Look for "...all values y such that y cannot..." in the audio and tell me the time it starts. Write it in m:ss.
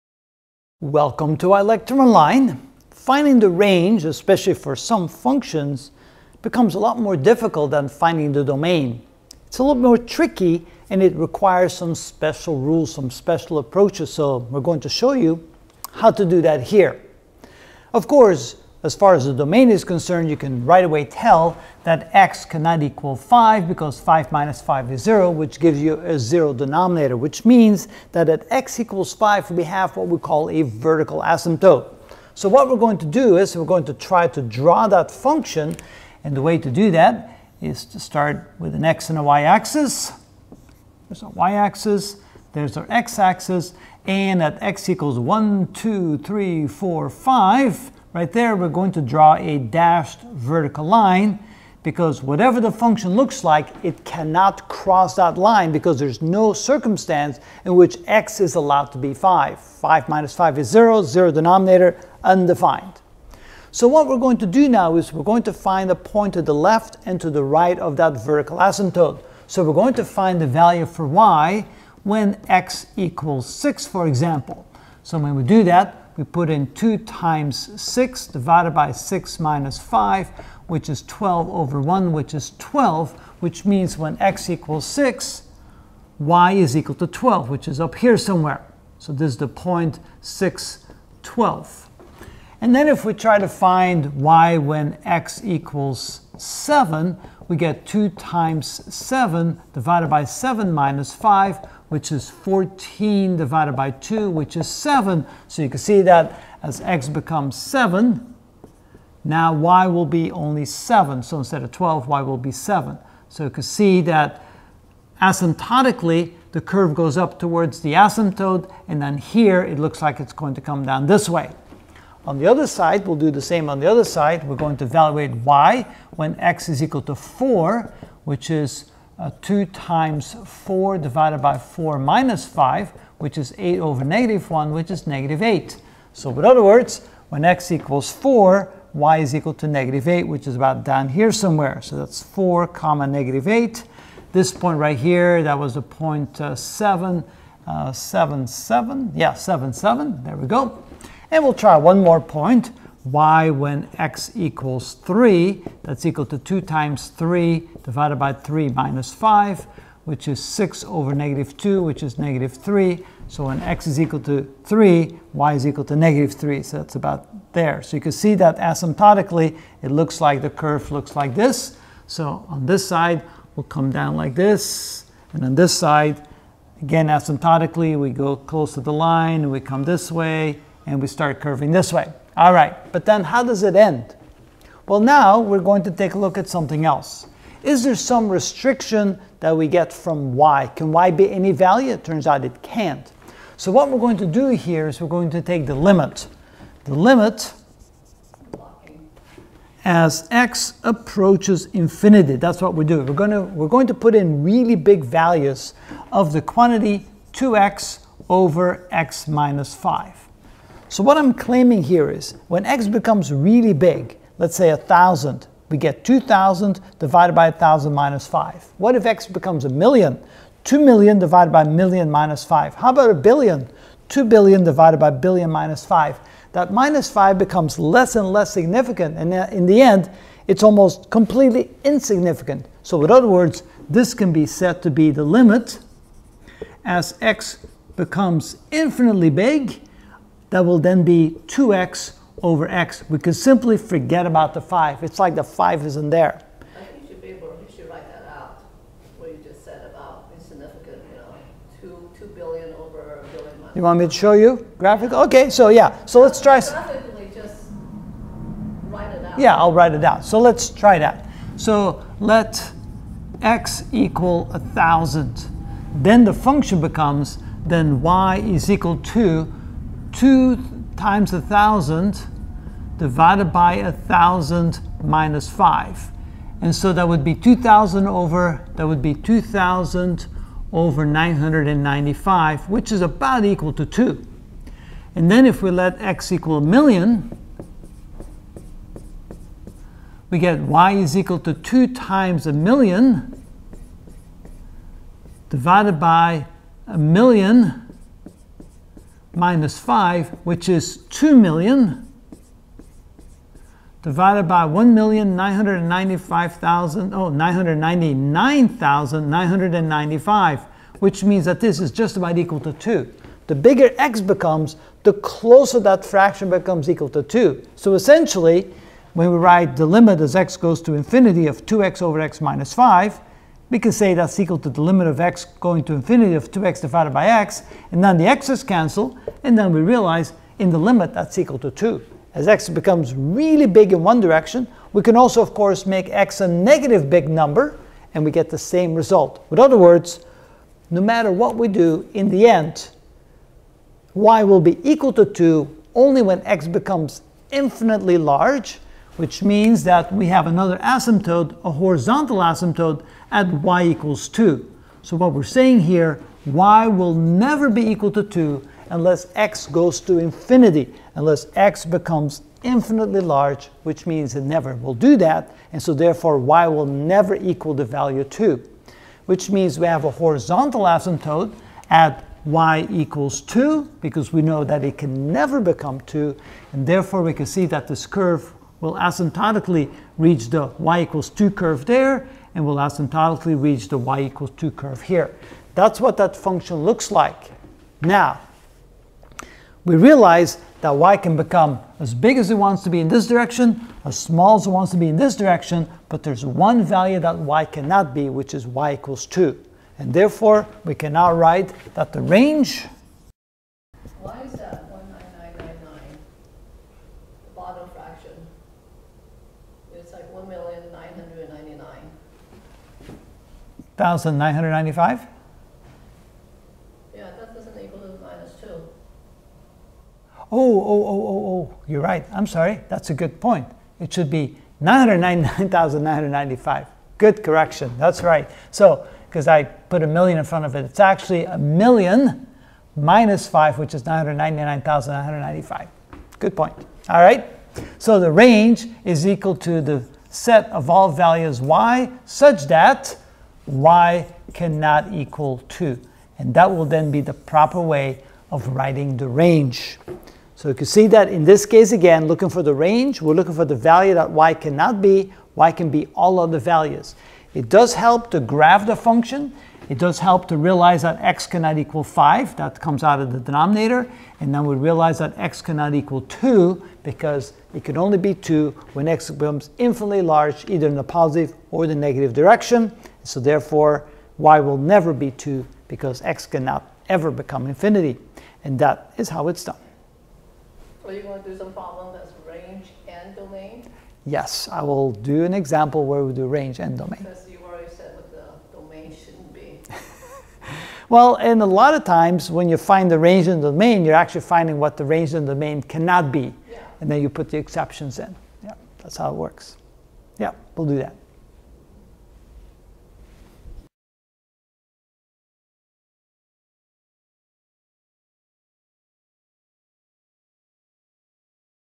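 7:20.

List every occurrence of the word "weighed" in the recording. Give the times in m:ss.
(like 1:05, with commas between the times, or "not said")
not said.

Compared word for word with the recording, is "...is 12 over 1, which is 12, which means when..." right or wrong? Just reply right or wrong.
right.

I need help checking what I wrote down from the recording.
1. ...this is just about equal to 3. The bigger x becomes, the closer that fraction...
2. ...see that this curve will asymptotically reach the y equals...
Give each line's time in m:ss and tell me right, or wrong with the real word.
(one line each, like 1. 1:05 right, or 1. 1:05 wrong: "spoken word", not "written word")
1. 5:11 wrong: "2", not "3"
2. 6:17 right.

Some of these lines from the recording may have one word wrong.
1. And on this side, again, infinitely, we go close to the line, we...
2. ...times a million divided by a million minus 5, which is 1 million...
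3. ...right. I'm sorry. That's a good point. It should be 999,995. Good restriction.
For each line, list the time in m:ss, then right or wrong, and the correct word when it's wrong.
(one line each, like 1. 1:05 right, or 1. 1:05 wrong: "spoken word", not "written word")
1. 2:55 wrong: "asymptotically", not "infinitely"
2. 4:51 wrong: "2", not "1"
3. 7:02 wrong: "correction", not "restriction".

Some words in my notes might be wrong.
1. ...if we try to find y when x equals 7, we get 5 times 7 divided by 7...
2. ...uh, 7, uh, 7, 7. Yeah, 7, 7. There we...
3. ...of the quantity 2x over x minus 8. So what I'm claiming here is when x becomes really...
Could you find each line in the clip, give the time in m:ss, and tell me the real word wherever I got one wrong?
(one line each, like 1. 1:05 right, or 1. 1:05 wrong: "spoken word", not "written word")
1. 1:32 wrong: "2", not "5"
2. 2:26 right
3. 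3:26 wrong: "5", not "8".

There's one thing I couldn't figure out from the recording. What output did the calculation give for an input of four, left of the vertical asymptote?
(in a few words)
-8.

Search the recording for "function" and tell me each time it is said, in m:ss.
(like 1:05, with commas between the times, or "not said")
0:05, 0:35, 0:52, 4:26, 6:26, 7:38.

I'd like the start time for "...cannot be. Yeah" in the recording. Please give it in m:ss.
8:15.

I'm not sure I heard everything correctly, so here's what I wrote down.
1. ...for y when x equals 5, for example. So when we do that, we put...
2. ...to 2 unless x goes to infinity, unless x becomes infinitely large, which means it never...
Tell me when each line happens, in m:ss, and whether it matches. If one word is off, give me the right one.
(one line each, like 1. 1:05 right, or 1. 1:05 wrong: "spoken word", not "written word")
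1. 1:10 wrong: "6", not "5"
2. 5:58 right.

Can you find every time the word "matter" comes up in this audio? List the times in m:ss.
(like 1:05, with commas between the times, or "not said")
5:40.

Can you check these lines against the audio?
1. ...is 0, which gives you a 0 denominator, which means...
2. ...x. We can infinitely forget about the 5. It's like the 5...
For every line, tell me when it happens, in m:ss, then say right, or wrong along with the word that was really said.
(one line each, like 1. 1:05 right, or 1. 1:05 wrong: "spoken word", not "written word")
1. 0:24 right
2. 4:02 wrong: "simply", not "infinitely".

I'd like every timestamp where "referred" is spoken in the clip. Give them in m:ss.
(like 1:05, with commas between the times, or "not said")
not said.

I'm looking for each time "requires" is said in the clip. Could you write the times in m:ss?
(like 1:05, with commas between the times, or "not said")
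0:11.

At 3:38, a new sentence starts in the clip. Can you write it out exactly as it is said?
What if x becomes a million?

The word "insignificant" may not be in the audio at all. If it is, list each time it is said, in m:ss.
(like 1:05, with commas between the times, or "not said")
3:51, 4:10.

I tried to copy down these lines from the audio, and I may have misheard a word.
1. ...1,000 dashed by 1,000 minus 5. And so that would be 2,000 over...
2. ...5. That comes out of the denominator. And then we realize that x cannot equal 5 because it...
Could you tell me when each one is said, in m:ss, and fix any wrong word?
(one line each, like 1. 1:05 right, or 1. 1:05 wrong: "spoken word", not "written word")
1. 4:31 wrong: "divided", not "dashed"
2. 7:42 wrong: "2", not "5".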